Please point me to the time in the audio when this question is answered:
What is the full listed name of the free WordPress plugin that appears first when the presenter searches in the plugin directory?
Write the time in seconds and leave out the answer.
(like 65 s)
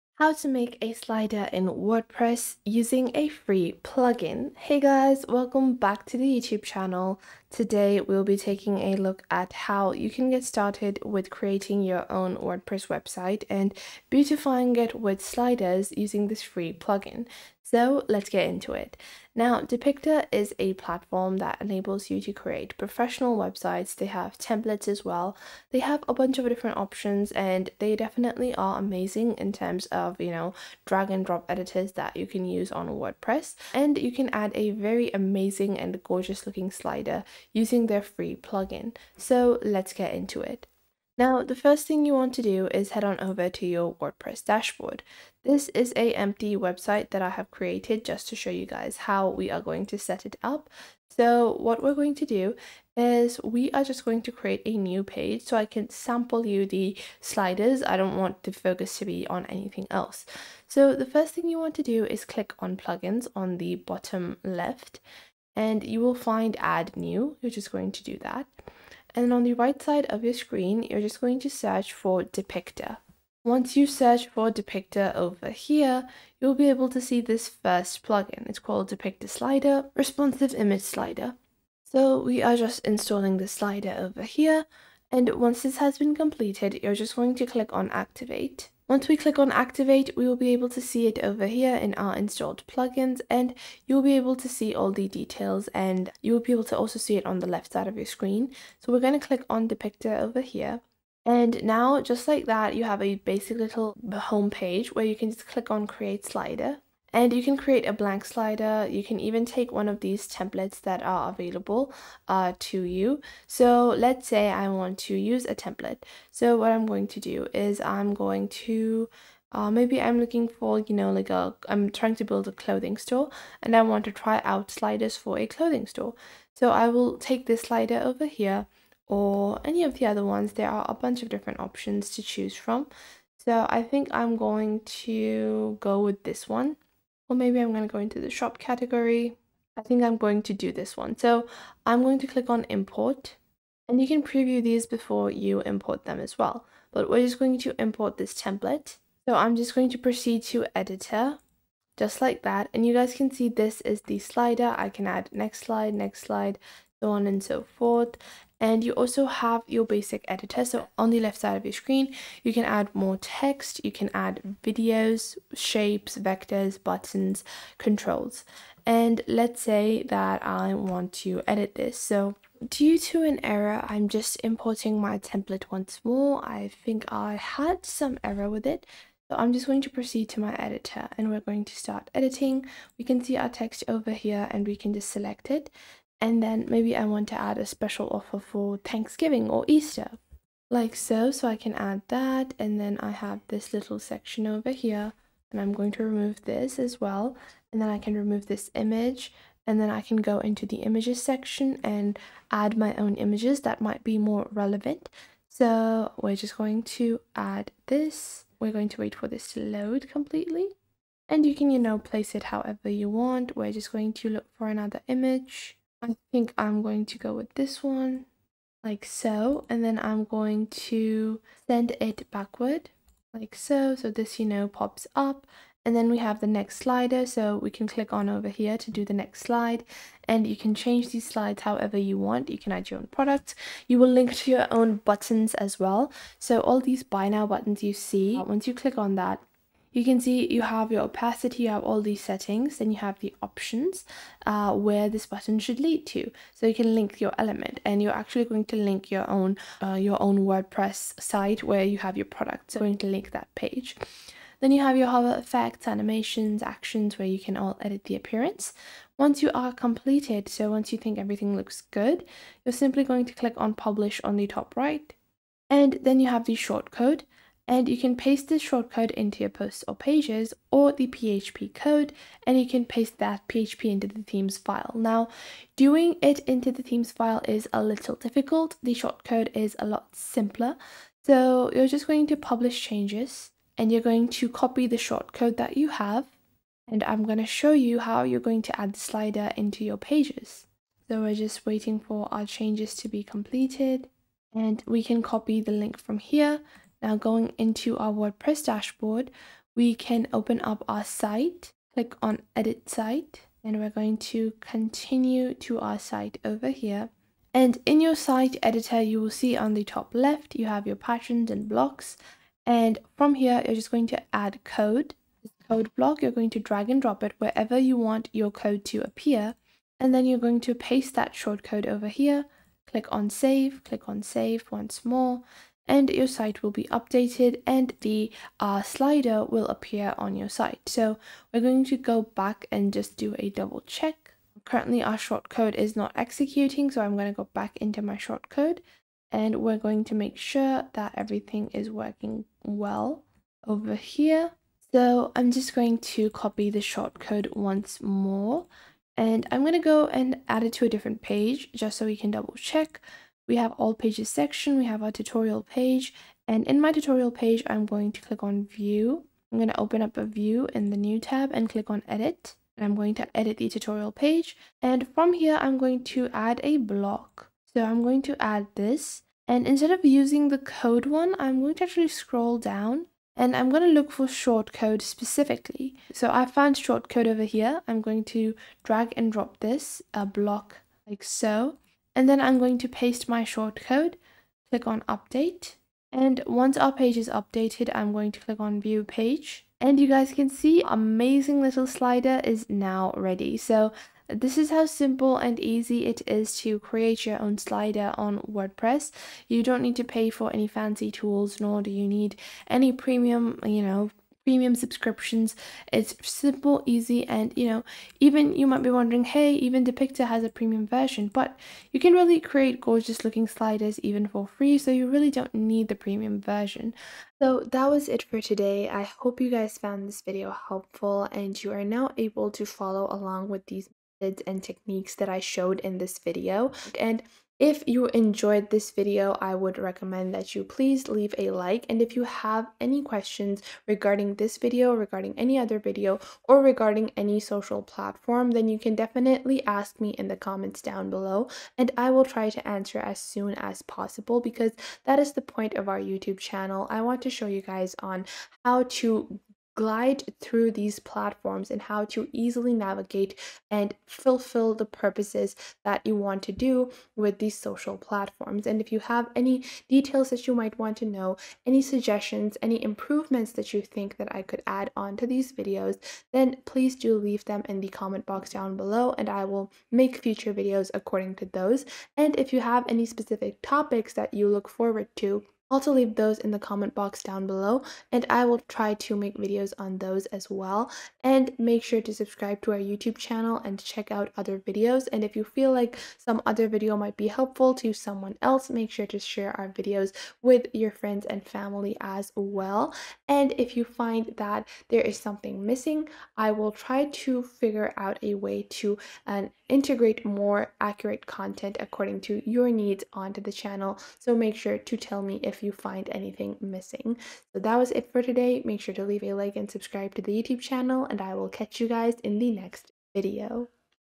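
78 s.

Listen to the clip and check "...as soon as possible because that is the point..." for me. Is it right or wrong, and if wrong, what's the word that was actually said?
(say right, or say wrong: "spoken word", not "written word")
right.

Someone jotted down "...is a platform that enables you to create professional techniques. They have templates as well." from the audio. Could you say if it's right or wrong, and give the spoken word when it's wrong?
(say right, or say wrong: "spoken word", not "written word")
wrong: "websites", not "techniques".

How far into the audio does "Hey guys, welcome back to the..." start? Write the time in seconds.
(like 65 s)
4 s.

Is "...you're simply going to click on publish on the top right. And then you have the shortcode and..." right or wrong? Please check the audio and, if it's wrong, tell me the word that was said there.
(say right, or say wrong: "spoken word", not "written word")
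right.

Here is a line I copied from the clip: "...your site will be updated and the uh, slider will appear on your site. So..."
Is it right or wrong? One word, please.
right.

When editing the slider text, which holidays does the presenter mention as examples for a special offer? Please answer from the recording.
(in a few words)
Thanksgiving or Easter.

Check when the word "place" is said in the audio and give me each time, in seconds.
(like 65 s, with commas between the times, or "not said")
211 s.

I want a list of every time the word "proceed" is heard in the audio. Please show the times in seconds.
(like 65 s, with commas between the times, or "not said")
149 s, 179 s.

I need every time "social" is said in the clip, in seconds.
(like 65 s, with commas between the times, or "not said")
437 s, 457 s.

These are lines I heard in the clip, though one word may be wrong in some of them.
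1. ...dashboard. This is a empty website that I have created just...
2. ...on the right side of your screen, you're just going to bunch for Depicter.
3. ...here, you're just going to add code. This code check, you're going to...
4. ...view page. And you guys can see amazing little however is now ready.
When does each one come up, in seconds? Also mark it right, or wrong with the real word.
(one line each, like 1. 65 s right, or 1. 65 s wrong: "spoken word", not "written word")
1. 44 s right
2. 69 s wrong: "search", not "bunch"
3. 313 s wrong: "block", not "check"
4. 388 s wrong: "slider", not "however".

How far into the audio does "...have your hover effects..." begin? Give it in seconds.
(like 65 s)
254 s.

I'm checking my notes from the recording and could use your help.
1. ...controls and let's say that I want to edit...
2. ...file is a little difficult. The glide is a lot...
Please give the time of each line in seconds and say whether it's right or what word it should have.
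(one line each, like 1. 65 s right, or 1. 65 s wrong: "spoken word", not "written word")
1. 167 s right
2. 277 s wrong: "shortcode", not "glide".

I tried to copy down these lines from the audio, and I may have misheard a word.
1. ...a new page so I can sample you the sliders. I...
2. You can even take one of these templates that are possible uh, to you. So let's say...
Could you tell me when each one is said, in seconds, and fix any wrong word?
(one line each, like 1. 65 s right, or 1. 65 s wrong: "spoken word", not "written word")
1. 54 s right
2. 108 s wrong: "available", not "possible".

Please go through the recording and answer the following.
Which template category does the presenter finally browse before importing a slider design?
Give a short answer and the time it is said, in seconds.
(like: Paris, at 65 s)
Shop, at 138 s.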